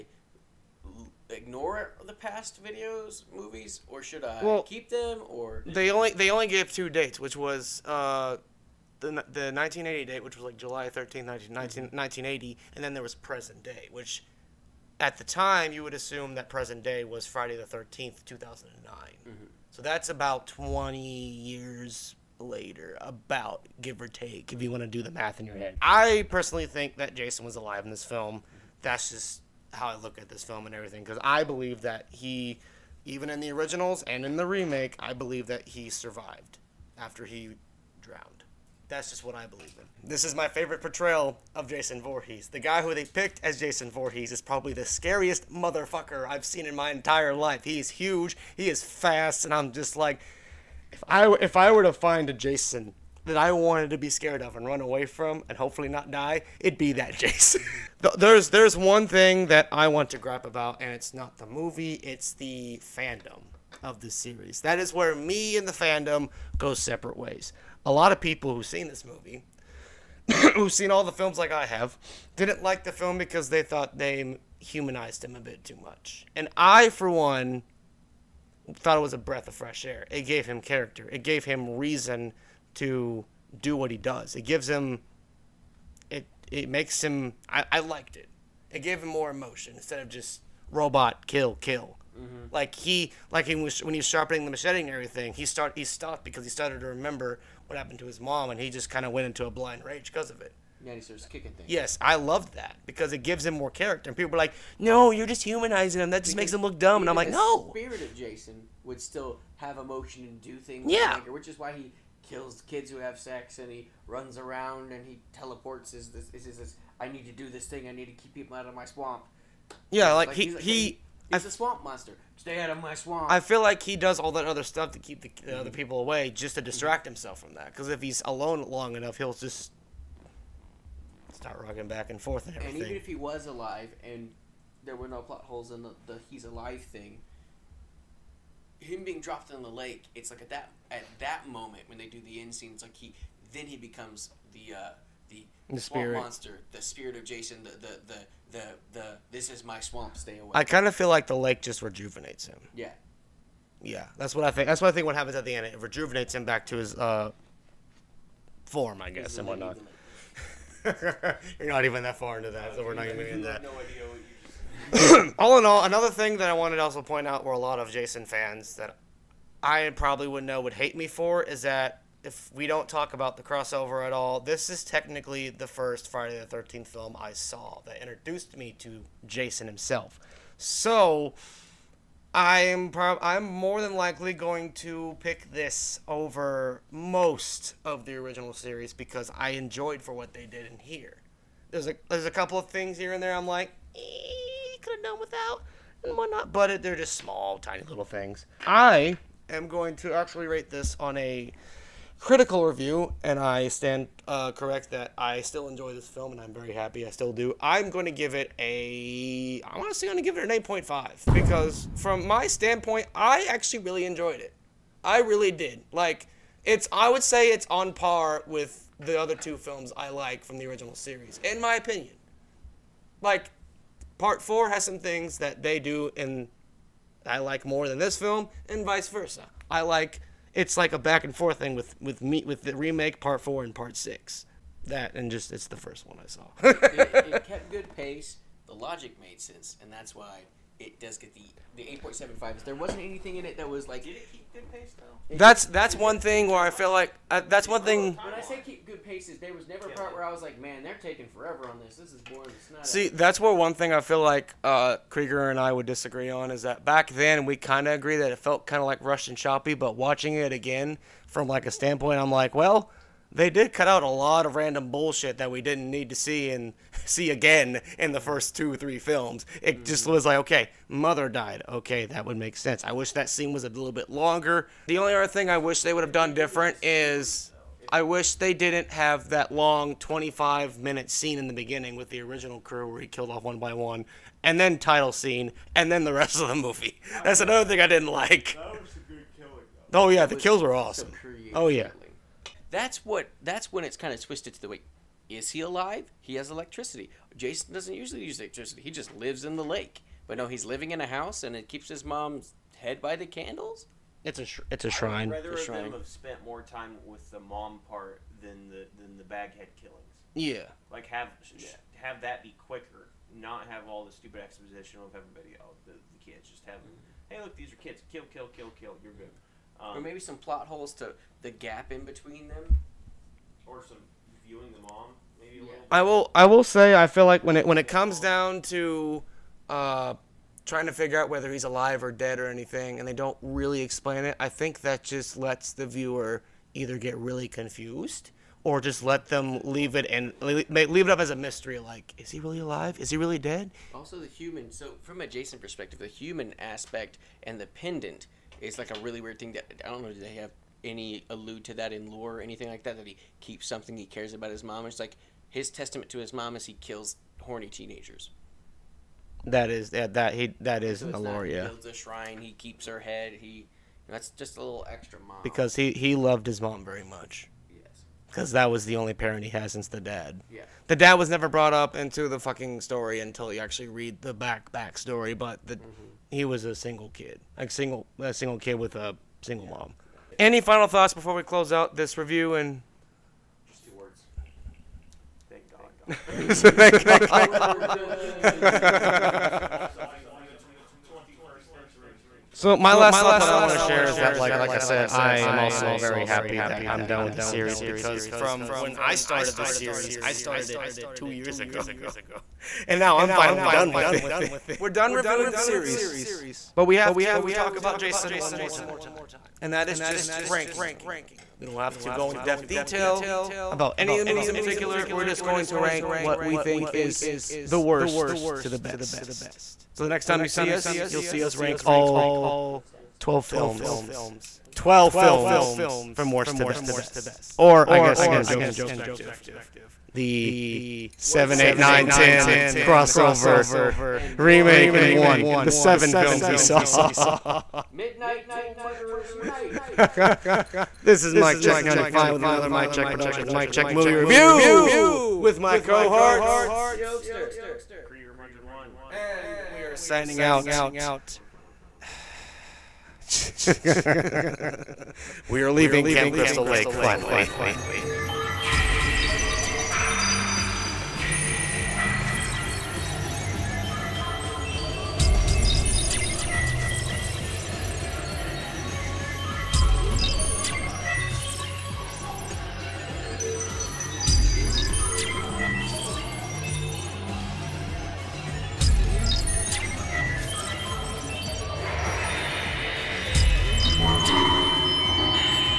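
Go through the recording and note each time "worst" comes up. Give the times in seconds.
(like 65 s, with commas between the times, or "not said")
417 s, 426 s.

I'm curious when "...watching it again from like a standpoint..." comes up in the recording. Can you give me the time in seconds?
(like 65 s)
259 s.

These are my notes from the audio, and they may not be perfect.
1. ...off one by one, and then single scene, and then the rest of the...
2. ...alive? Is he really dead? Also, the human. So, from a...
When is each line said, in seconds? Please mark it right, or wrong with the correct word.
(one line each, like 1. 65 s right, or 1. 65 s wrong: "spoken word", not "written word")
1. 283 s wrong: "title", not "single"
2. 342 s right.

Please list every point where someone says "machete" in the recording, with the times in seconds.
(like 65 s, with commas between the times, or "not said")
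94 s.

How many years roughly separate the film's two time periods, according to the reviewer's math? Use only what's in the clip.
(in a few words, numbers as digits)
20 years.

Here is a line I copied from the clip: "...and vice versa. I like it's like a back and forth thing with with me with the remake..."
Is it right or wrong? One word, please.
right.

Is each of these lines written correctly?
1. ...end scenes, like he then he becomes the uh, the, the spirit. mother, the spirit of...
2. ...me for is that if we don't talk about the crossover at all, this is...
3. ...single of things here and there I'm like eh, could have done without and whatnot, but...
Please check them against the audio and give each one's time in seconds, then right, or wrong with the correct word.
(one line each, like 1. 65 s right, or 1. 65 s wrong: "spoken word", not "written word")
1. 142 s wrong: "monster", not "mother"
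2. 170 s right
3. 192 s wrong: "couple", not "single".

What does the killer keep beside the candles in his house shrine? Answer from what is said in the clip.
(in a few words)
His mom's head.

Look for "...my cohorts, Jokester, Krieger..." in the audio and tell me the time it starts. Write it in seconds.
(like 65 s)
445 s.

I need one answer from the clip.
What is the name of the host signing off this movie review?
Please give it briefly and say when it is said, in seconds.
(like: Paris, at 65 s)
MykeCheck95, at 441 s.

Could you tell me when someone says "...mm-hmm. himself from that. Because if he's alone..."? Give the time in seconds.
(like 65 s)
127 s.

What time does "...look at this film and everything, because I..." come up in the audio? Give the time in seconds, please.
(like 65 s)
29 s.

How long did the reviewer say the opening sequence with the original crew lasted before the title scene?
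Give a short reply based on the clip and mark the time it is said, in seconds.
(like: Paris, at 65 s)
25 minutes, at 279 s.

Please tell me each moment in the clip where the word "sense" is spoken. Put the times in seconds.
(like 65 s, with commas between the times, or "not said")
239 s, 272 s.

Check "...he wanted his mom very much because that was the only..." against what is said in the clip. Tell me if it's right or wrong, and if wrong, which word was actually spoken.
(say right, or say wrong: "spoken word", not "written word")
wrong: "loved", not "wanted".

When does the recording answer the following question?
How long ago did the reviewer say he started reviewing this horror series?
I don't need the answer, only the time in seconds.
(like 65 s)
401 s.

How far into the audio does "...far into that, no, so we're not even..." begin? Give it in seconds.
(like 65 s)
162 s.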